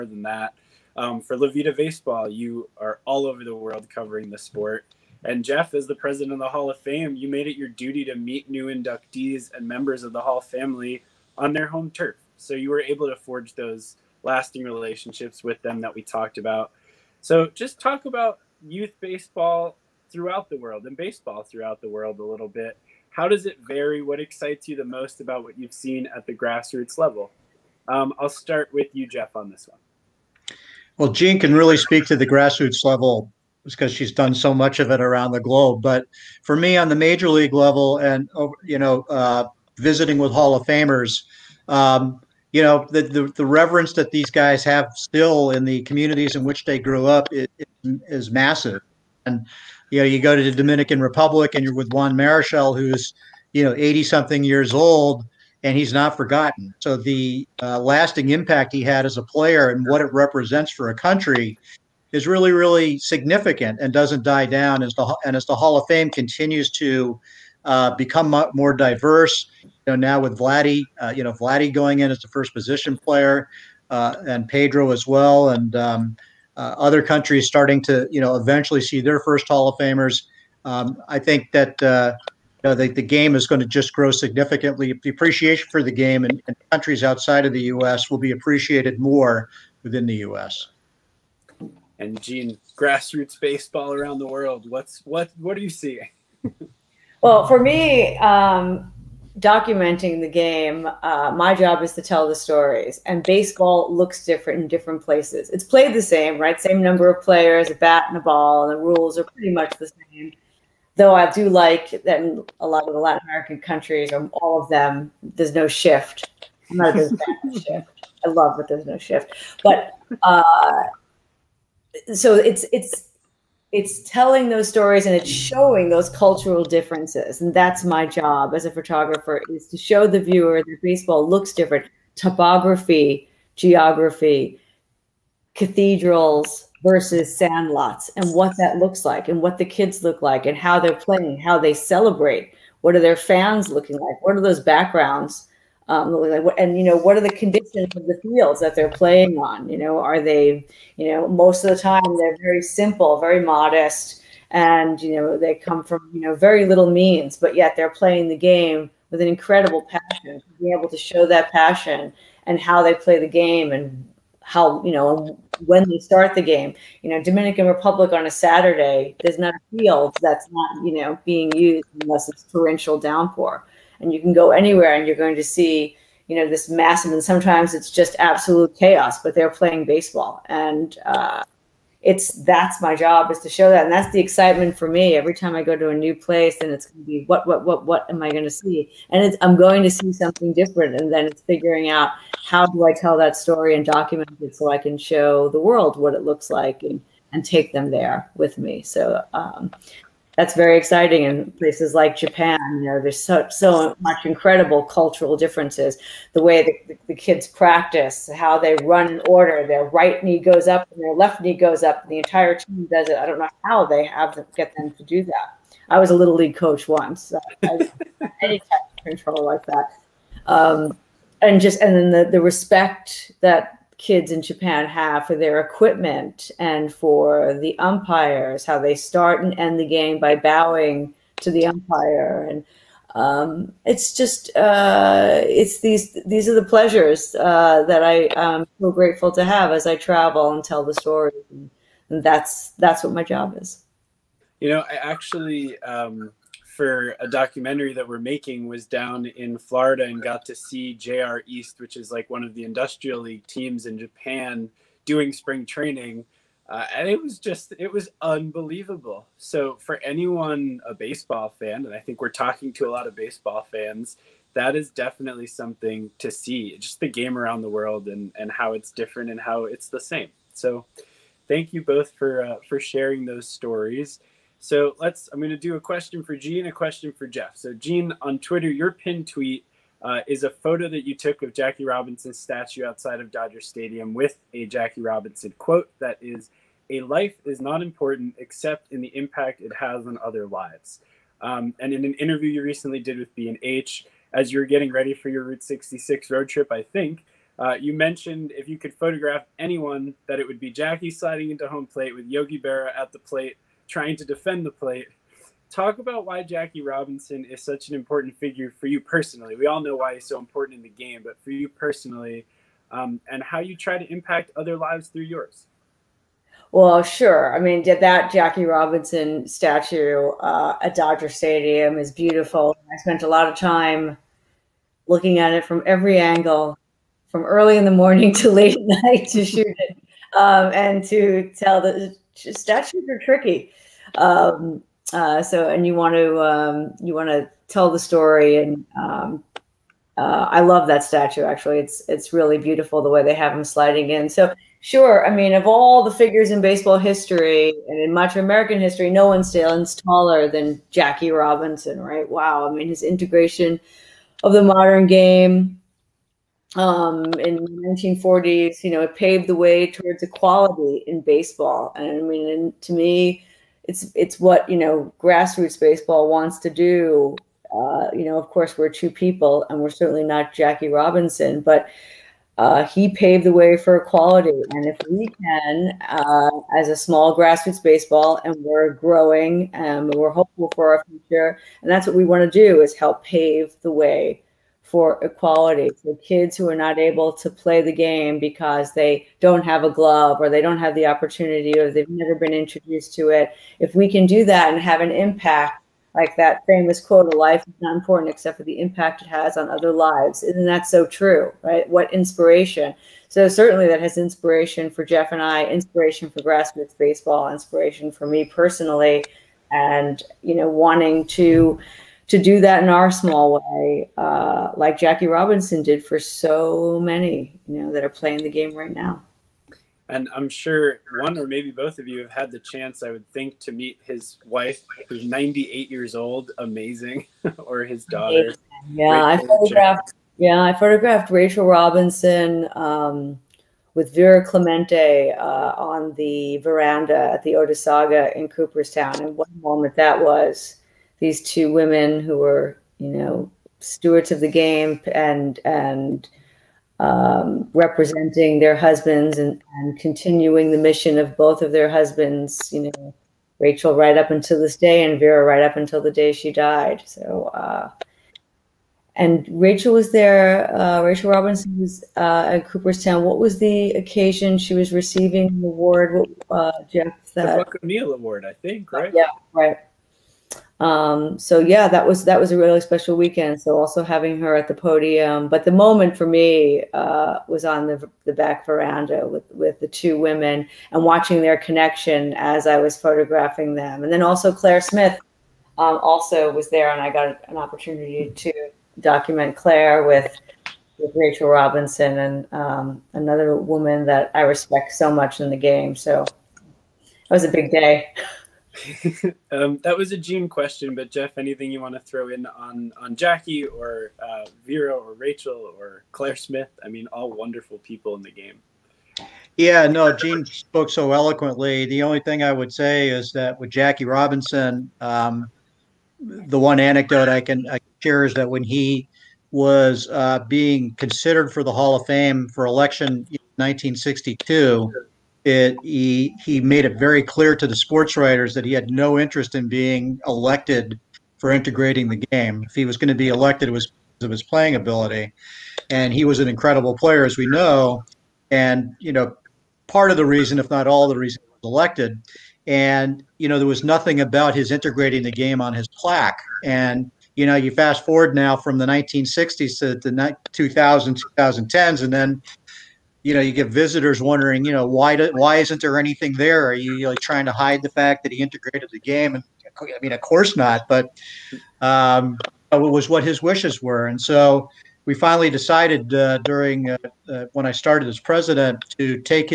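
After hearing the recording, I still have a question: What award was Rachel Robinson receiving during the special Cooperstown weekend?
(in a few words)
Buck O'Neil Award.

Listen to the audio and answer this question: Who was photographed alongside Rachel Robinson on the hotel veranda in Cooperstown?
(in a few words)
Vera Clemente.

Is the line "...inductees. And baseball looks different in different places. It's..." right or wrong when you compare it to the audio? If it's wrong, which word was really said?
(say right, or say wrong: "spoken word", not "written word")
wrong: "stories", not "inductees".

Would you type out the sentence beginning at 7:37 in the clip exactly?
So, uh, and Rachel was there, uh, Rachel Robinson was uh, at Cooperstown.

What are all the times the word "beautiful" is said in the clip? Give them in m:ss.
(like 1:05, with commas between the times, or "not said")
5:22, 5:42.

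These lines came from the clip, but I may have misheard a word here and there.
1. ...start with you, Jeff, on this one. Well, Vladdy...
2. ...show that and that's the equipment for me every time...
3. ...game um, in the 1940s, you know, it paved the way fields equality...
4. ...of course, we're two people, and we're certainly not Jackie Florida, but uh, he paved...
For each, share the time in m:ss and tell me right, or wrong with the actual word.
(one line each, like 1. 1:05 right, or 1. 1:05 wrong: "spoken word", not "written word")
1. 0:28 wrong: "Jean", not "Vladdy"
2. 3:03 wrong: "excitement", not "equipment"
3. 5:55 wrong: "towards", not "fields"
4. 6:08 wrong: "Robinson", not "Florida".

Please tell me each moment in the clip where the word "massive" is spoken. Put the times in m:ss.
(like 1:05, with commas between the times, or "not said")
0:48, 2:56.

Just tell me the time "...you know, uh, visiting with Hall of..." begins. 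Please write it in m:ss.
0:38.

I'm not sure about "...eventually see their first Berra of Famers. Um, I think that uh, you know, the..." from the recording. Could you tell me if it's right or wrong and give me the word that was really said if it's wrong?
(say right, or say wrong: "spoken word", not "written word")
wrong: "Hall", not "Berra".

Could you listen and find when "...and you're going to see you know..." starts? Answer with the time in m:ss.
2:54.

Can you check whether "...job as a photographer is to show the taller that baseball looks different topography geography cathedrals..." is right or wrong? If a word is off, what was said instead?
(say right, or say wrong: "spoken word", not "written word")
wrong: "viewer", not "taller".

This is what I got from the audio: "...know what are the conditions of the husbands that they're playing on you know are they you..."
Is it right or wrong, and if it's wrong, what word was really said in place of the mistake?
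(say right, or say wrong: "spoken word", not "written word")
wrong: "fields", not "husbands".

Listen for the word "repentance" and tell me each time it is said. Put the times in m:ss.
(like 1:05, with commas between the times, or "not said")
not said.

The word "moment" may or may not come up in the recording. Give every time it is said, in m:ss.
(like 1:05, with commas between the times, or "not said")
7:19, 7:55.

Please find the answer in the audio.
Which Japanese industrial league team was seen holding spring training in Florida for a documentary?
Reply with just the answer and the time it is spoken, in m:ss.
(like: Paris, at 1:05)
JR East, at 4:10.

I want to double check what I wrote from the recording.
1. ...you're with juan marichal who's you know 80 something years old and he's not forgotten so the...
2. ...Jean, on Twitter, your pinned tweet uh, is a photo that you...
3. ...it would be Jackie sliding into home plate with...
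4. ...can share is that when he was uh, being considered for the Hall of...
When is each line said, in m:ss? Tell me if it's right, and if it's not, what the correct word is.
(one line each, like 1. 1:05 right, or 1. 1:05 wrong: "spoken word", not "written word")
1. 0:51 right
2. 4:37 right
3. 5:00 right
4. 8:37 right.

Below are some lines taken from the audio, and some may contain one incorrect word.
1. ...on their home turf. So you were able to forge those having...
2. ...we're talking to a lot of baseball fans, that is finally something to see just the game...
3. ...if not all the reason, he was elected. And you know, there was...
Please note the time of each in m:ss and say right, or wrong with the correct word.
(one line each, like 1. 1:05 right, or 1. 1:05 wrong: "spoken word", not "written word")
1. 0:11 wrong: "lasting", not "having"
2. 4:22 wrong: "definitely", not "finally"
3. 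9:00 right.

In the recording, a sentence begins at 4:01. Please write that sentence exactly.
And that's that's what my job is.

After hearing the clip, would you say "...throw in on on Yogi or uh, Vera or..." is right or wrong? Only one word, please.
wrong.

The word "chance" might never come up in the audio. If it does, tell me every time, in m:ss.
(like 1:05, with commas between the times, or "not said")
7:02.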